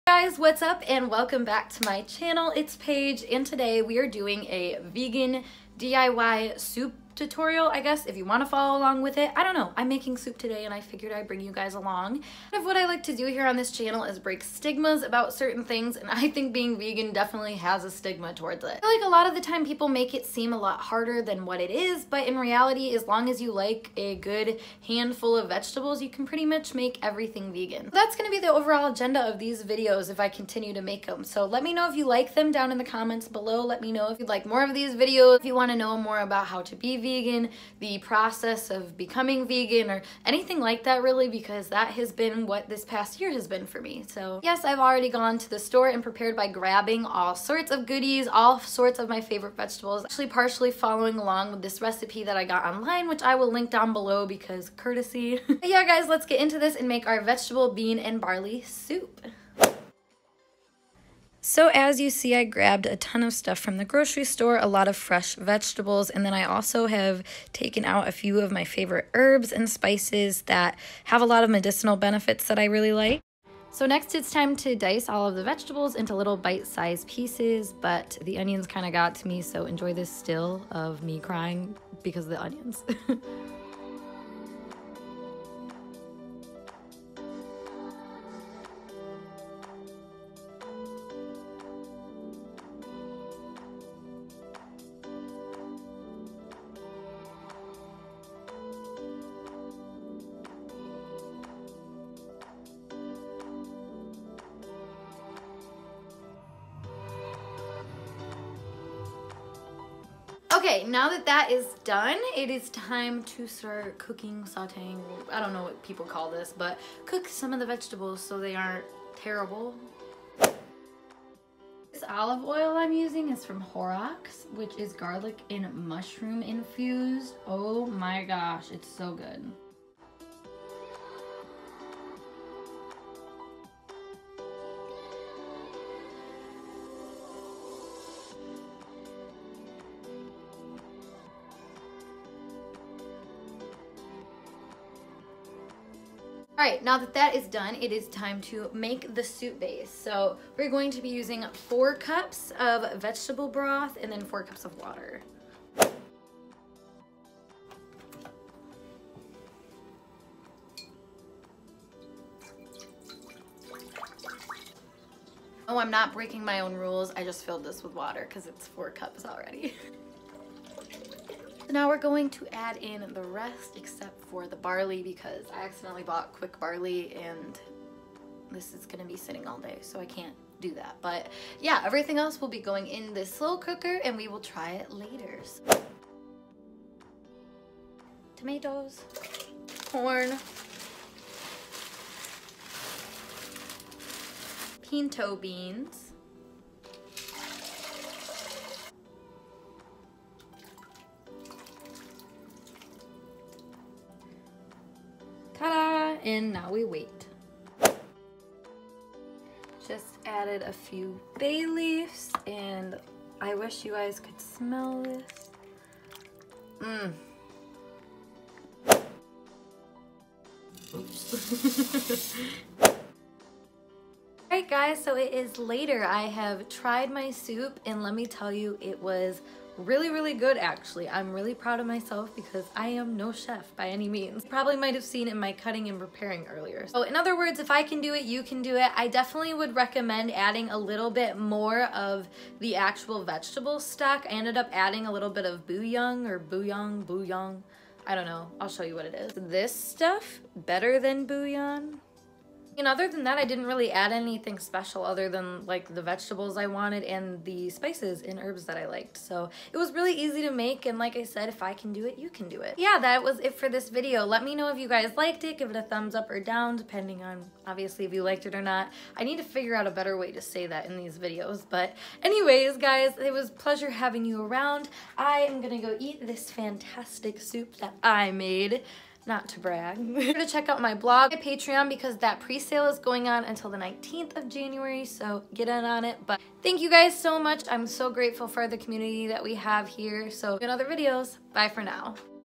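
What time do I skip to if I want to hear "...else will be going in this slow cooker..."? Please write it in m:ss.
3:02.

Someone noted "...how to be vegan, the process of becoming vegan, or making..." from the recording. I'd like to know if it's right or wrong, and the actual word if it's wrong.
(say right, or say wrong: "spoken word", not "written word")
wrong: "anything", not "making".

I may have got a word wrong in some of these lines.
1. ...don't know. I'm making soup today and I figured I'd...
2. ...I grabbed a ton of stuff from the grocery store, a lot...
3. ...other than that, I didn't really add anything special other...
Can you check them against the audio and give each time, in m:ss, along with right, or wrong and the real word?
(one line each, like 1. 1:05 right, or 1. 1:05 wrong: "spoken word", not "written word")
1. 0:09 right
2. 1:02 right
3. 4:12 right.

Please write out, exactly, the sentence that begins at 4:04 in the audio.
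I ended up adding a little bit of bouillon or bouillon, bouillon.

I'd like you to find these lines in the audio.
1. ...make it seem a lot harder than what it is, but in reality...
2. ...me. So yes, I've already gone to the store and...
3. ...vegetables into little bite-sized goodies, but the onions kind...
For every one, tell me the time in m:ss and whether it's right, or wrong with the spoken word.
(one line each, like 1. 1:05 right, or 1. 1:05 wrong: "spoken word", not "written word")
1. 0:19 right
2. 0:43 right
3. 1:15 wrong: "pieces", not "goodies".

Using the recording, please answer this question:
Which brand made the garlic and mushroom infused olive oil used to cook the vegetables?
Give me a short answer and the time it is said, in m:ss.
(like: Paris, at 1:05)
Horrocks, at 2:03.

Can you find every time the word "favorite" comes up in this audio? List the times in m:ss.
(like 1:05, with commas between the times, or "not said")
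0:49, 1:08.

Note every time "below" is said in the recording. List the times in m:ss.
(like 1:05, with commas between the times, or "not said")
0:33, 0:53.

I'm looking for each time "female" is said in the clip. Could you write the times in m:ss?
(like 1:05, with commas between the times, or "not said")
not said.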